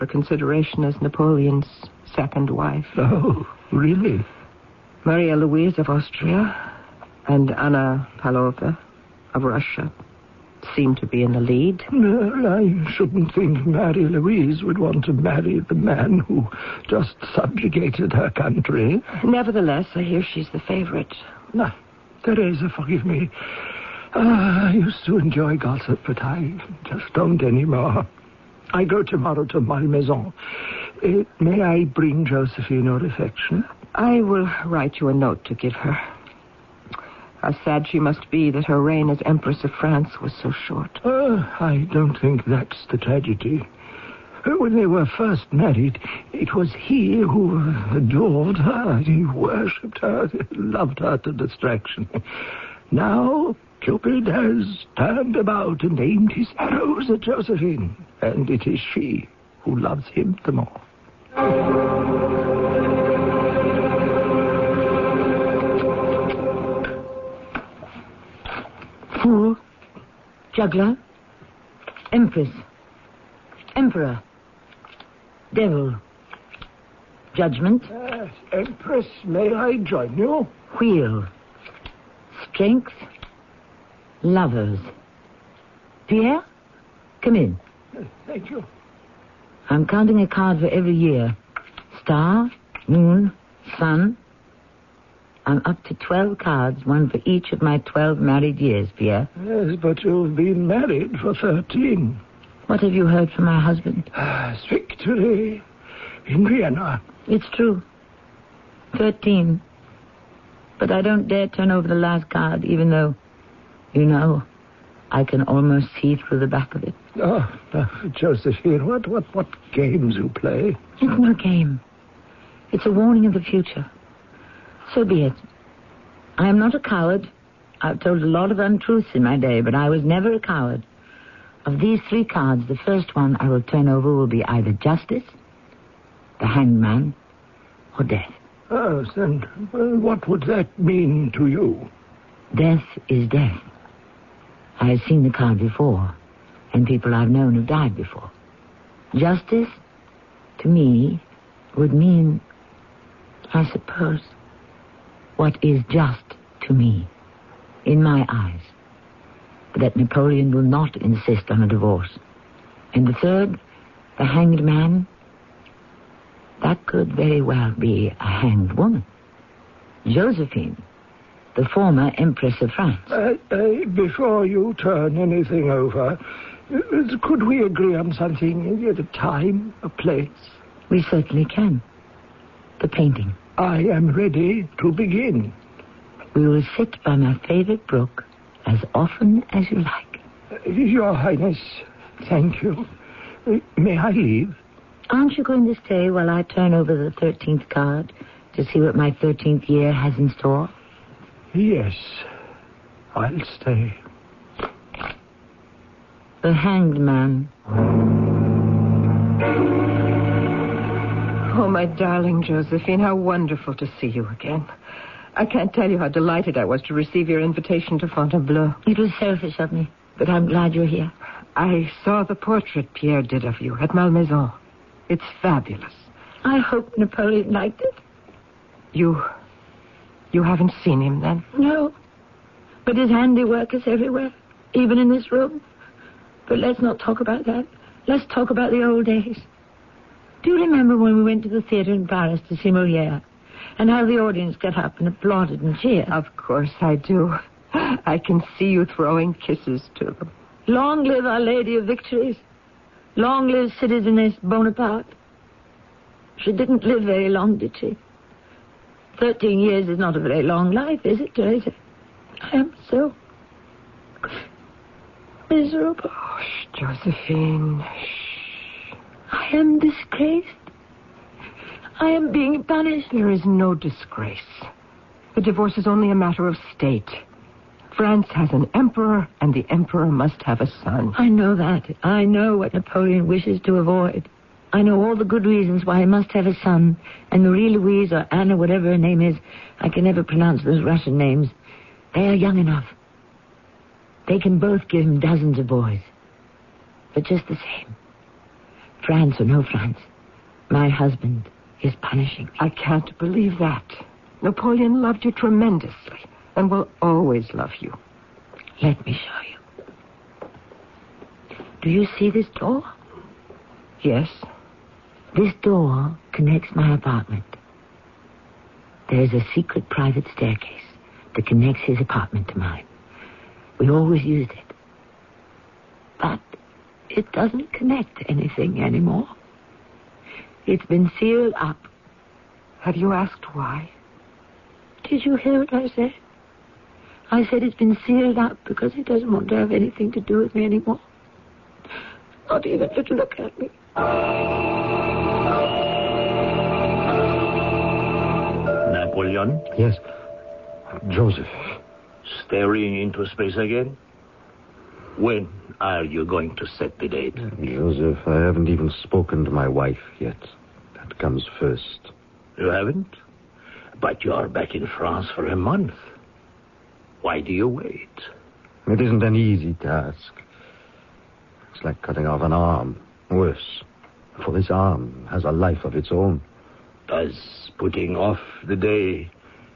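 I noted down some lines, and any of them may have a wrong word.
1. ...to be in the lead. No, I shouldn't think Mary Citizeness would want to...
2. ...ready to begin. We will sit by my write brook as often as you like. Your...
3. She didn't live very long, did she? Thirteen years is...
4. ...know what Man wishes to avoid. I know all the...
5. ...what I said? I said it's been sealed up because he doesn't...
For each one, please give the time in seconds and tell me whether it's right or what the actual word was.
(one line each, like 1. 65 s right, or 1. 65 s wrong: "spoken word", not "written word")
1. 10 s wrong: "Louise", not "Citizeness"
2. 184 s wrong: "favorite", not "write"
3. 256 s right
4. 282 s wrong: "Napoleon", not "Man"
5. 335 s right.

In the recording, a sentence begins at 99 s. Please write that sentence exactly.
Yes, but you've been married for 13.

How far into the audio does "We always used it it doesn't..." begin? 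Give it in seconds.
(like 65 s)
323 s.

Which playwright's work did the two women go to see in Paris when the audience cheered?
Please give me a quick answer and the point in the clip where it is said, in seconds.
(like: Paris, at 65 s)
Moliere, at 242 s.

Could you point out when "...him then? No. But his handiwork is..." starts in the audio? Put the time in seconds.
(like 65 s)
231 s.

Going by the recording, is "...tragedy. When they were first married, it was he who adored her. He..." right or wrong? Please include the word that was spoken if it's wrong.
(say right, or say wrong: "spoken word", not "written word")
right.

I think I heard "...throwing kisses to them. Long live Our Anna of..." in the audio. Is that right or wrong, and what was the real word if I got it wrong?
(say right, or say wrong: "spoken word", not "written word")
wrong: "Lady", not "Anna".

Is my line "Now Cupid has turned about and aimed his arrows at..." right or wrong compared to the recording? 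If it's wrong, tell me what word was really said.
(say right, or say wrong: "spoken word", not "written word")
right.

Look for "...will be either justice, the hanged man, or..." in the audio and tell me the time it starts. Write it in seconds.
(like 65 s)
134 s.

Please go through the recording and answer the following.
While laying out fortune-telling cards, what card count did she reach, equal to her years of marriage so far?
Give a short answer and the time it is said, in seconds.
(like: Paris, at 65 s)
12, at 95 s.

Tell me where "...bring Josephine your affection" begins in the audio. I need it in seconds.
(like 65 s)
31 s.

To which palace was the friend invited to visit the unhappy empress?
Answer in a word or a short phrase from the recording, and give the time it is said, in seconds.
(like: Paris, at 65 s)
Fontainebleau, at 218 s.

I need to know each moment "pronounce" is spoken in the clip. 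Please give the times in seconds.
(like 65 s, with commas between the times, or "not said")
290 s.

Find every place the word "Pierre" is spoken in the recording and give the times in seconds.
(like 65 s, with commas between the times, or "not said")
86 s, 98 s, 222 s.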